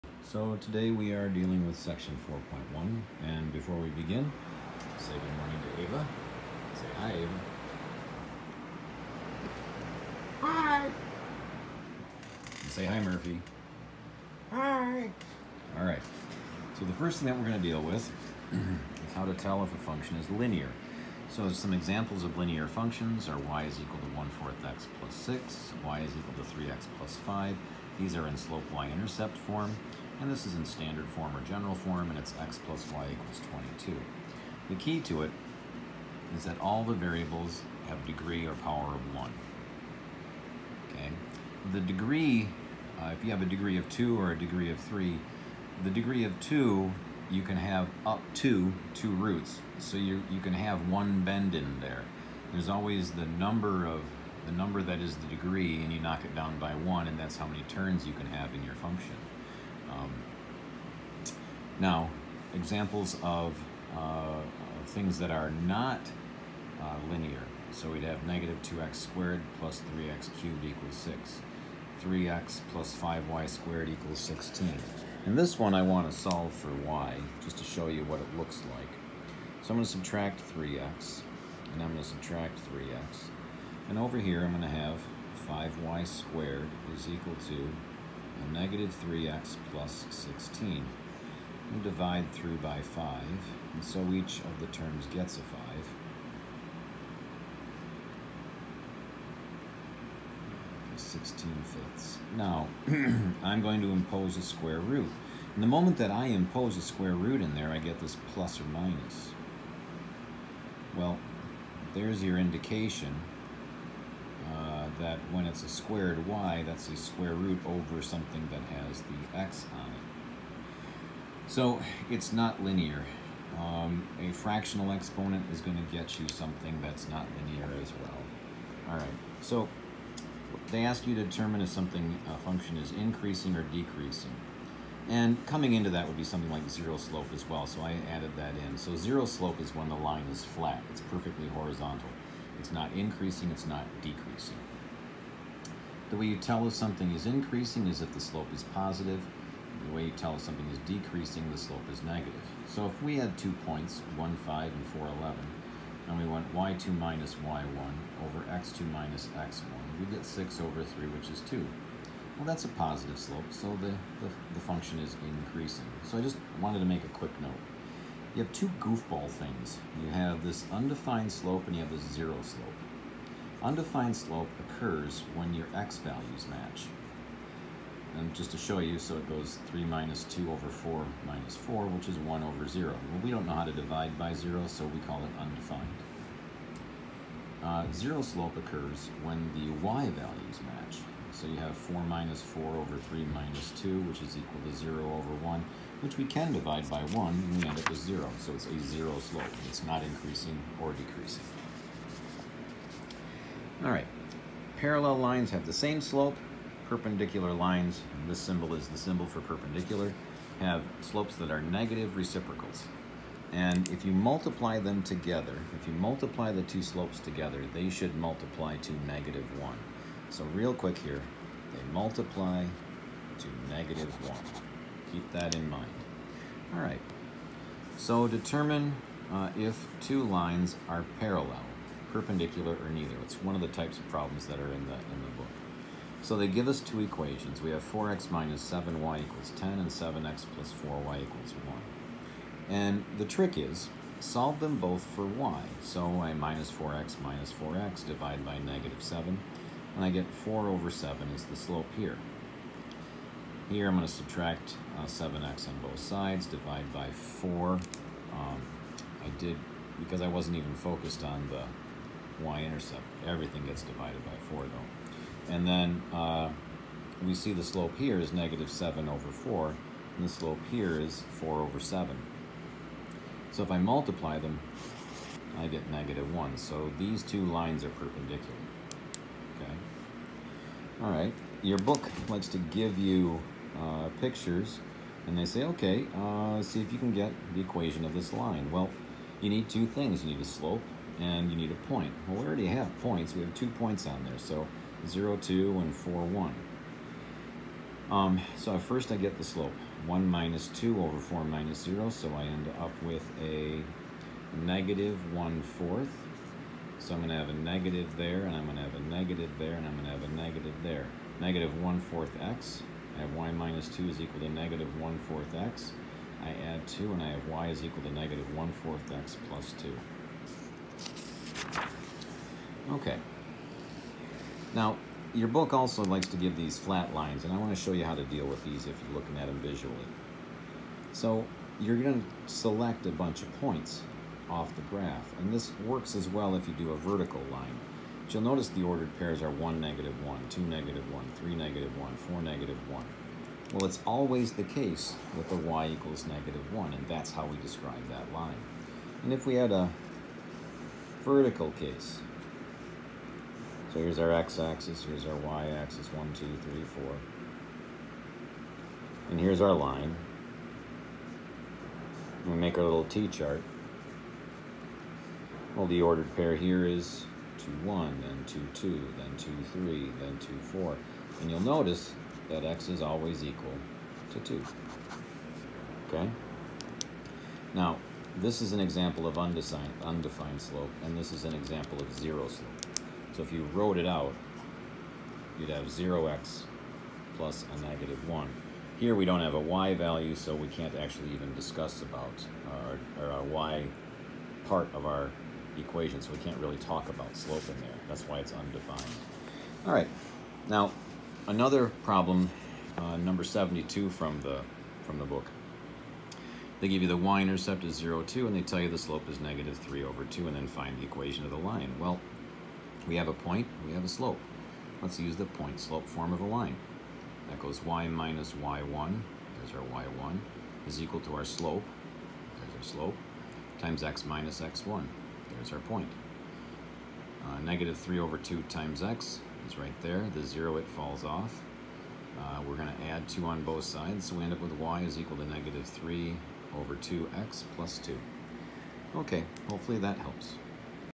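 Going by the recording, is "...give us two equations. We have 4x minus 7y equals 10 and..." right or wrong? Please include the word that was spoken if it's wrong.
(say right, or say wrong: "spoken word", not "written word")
right.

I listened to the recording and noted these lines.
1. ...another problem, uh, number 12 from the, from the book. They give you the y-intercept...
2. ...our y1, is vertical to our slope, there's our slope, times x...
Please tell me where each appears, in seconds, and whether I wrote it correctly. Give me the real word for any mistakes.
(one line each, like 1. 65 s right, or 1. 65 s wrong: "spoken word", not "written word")
1. 401 s wrong: "72", not "12"
2. 419 s wrong: "equal", not "vertical".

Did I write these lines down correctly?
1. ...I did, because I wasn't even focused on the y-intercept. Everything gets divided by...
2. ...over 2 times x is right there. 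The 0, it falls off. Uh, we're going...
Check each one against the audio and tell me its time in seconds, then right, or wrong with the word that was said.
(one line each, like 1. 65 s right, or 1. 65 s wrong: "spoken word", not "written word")
1. 259 s right
2. 428 s right.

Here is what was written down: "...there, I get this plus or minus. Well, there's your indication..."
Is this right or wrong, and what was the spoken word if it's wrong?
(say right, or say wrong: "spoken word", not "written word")
right.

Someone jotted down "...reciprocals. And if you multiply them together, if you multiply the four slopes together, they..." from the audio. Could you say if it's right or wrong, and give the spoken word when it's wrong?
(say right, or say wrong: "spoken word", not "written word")
wrong: "two", not "four".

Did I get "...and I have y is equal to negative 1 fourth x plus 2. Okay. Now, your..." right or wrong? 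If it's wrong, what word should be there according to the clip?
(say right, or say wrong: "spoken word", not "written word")
right.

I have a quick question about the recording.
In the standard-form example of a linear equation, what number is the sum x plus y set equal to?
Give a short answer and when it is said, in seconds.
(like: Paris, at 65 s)
22, at 33 s.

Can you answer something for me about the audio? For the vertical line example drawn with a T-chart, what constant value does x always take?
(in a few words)
2.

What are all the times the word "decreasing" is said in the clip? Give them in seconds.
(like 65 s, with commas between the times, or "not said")
133 s, 144 s, 150 s, 200 s.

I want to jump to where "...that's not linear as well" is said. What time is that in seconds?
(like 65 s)
126 s.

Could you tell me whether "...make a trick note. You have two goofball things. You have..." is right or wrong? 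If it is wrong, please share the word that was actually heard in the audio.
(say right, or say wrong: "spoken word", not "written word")
wrong: "quick", not "trick".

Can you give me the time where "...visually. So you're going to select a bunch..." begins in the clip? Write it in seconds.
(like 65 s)
329 s.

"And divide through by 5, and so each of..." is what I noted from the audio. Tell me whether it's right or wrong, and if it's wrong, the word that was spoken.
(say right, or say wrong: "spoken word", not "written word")
right.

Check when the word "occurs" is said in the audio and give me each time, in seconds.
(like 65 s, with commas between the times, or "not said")
174 s, 188 s.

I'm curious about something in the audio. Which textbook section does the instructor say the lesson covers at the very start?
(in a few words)
4.1.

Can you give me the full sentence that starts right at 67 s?
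So we'd have negative 2x squared plus 3x cubed equals 6.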